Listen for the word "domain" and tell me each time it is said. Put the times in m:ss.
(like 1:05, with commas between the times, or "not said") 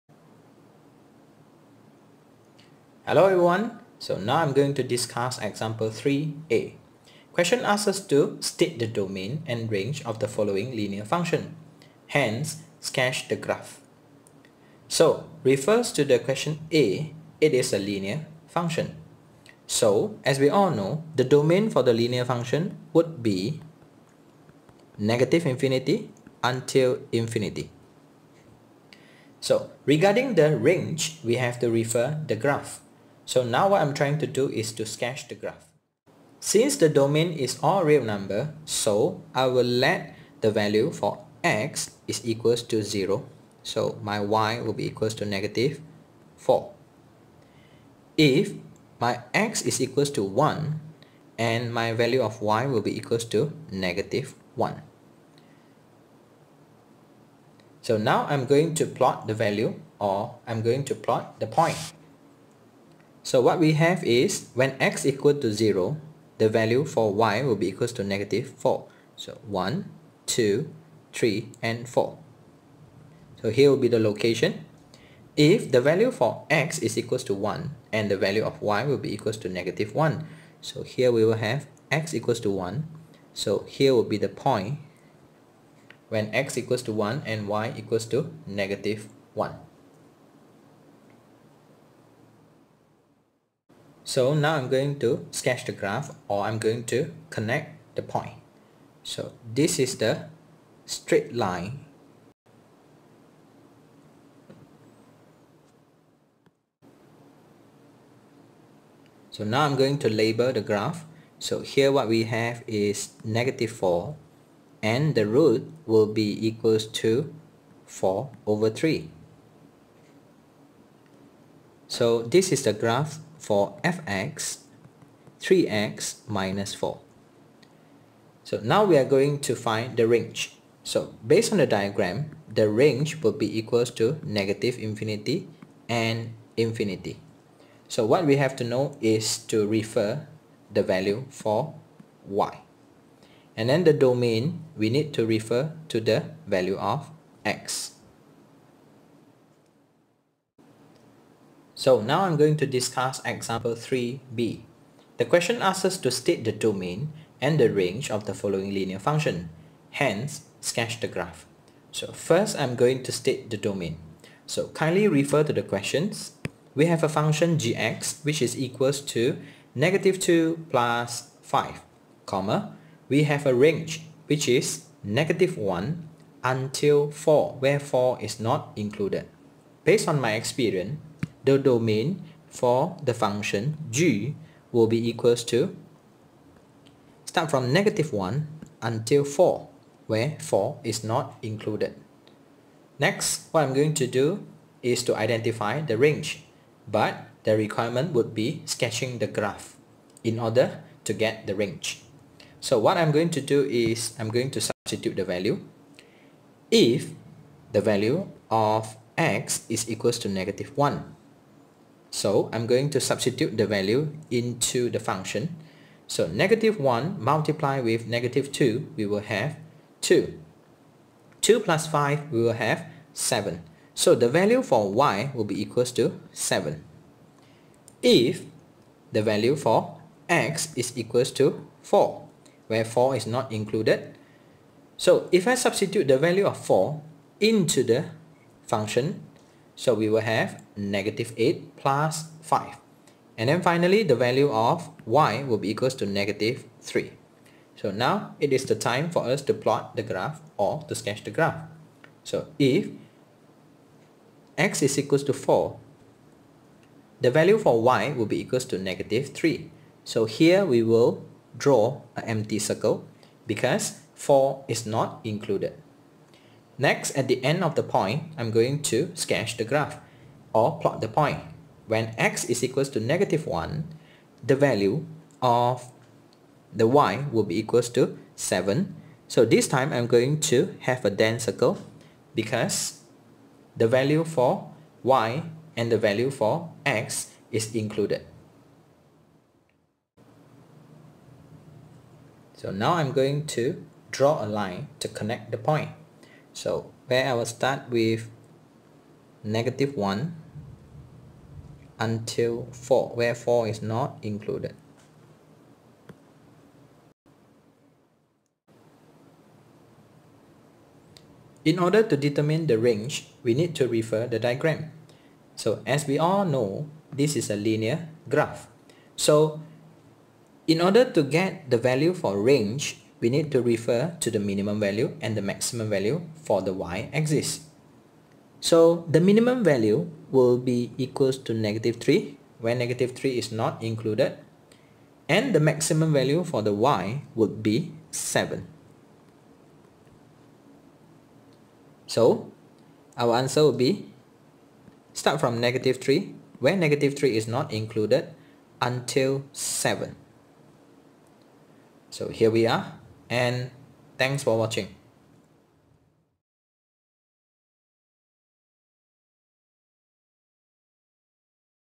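0:08, 0:21, 0:36, 2:23, 2:36, 2:43, 3:01.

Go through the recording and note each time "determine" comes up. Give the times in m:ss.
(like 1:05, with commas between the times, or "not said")
5:12.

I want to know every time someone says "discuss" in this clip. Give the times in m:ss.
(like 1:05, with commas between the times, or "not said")
0:04, 2:32.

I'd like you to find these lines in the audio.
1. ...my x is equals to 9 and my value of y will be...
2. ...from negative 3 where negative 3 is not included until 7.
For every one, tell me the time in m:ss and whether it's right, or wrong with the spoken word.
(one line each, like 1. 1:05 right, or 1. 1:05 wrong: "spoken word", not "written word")
1. 0:48 wrong: "1", not "9"
2. 5:45 right.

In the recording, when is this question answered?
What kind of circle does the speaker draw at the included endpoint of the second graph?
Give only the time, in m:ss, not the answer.
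4:41.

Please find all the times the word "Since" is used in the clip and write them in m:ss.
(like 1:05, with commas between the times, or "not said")
0:36.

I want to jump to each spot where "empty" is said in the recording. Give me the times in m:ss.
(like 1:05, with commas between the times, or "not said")
4:22.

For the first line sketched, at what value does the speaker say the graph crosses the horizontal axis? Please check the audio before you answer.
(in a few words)
4/3.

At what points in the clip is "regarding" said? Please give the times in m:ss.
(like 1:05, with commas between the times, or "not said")
0:29.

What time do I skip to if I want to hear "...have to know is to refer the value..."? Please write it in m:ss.
2:18.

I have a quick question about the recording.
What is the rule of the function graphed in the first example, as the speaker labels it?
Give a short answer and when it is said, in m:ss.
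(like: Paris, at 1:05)
3x - 4, at 2:05.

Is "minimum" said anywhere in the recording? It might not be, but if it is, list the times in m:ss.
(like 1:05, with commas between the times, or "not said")
5:24, 5:29.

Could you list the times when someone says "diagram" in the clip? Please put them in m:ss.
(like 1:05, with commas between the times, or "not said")
2:11, 5:14.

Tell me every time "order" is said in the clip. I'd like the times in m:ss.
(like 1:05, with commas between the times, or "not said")
3:20, 5:11, 5:20.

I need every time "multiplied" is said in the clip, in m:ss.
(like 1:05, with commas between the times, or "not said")
3:37.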